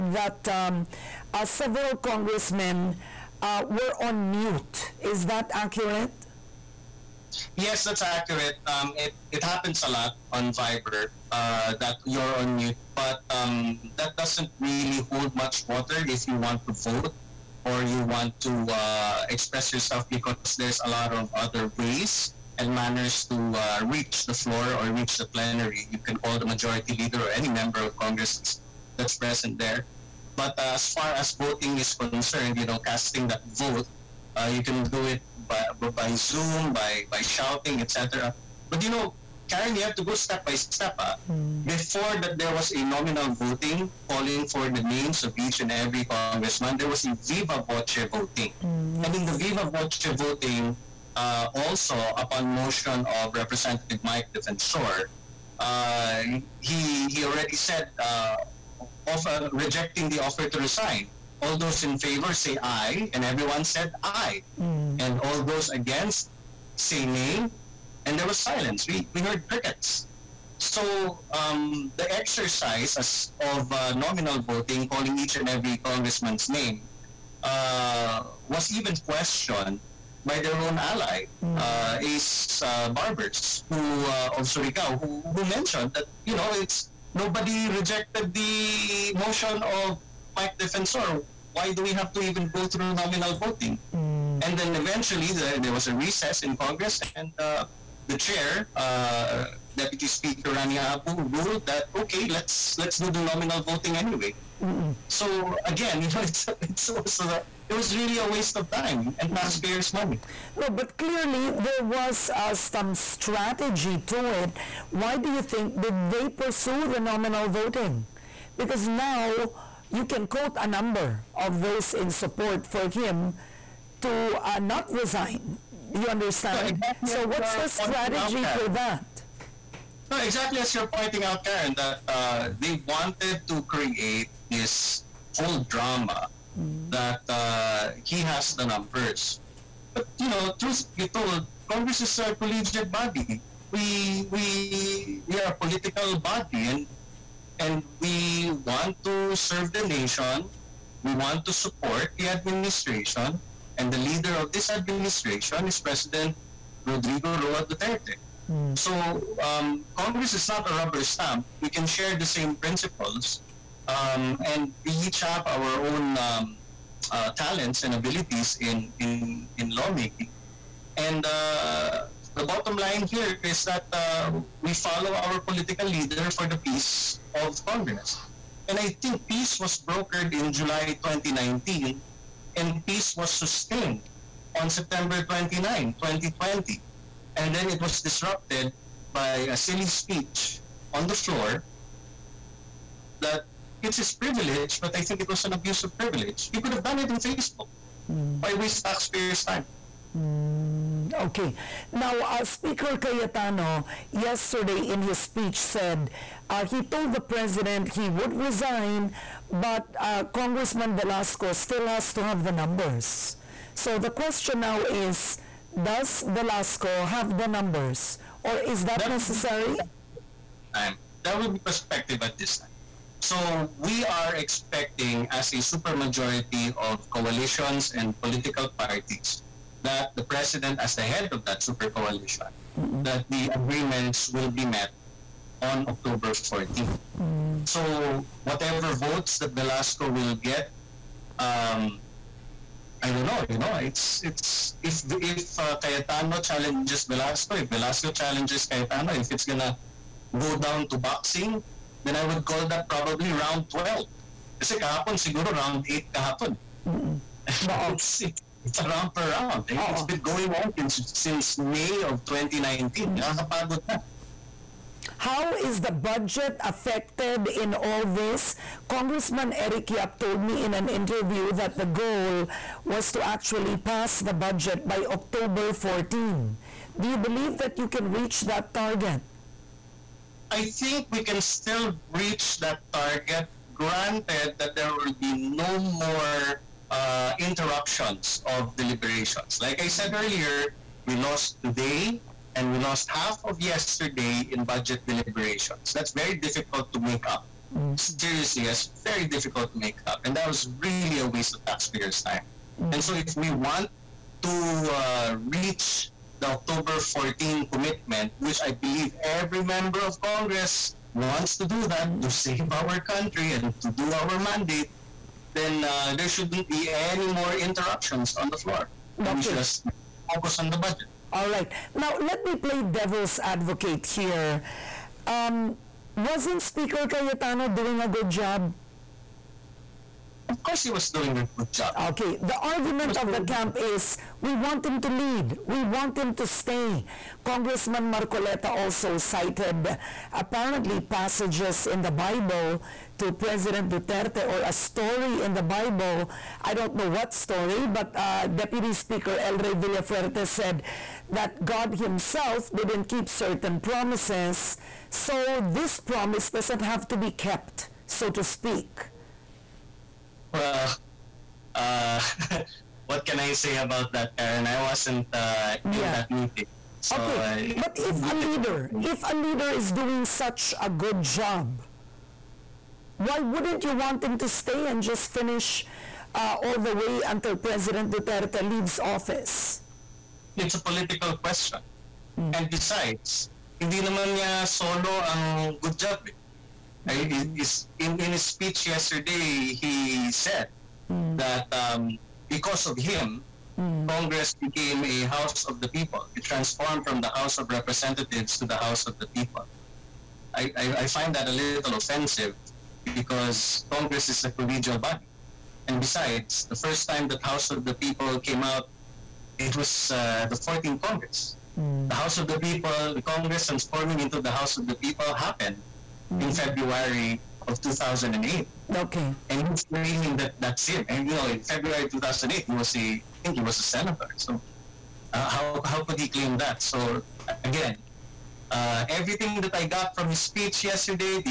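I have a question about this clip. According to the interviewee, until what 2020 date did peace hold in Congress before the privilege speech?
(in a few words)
September 29.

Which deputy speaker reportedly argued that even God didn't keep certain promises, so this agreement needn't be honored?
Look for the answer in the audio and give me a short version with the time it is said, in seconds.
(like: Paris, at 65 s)
LRay Villafuerte, at 349 s.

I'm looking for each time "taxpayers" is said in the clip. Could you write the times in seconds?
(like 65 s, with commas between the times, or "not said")
109 s, 198 s, 301 s.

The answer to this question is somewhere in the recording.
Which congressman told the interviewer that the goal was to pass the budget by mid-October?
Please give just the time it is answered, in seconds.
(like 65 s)
269 s.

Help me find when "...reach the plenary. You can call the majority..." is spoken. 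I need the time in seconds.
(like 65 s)
24 s.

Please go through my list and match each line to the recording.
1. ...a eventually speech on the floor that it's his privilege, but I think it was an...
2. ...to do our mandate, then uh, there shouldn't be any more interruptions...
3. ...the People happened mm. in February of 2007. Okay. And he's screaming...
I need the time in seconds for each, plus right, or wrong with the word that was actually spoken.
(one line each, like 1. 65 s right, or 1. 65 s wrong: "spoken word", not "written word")
1. 189 s wrong: "silly", not "eventually"
2. 313 s right
3. 414 s wrong: "2008", not "2007".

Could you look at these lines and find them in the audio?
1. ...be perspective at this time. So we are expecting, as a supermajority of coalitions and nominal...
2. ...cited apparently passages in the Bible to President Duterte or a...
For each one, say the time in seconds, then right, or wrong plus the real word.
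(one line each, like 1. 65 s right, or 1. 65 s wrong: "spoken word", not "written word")
1. 221 s wrong: "political", not "nominal"
2. 339 s right.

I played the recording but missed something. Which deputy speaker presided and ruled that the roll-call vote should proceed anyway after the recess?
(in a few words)
Ranie Abu.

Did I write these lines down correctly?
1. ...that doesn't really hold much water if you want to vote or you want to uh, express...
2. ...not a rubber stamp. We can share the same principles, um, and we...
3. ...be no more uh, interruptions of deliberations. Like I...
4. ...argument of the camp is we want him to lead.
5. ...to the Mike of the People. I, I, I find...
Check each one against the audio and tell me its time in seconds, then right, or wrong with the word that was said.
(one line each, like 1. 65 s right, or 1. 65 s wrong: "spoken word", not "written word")
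1. 13 s right
2. 160 s right
3. 285 s right
4. 332 s right
5. 398 s wrong: "House", not "Mike".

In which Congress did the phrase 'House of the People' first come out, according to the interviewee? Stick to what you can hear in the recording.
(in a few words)
14th Congress.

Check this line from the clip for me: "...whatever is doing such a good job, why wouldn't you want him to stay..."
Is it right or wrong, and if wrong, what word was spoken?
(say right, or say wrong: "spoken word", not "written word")
wrong: "leader", not "whatever".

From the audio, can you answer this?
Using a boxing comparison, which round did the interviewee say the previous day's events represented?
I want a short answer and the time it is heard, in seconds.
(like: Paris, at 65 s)
round 8, at 255 s.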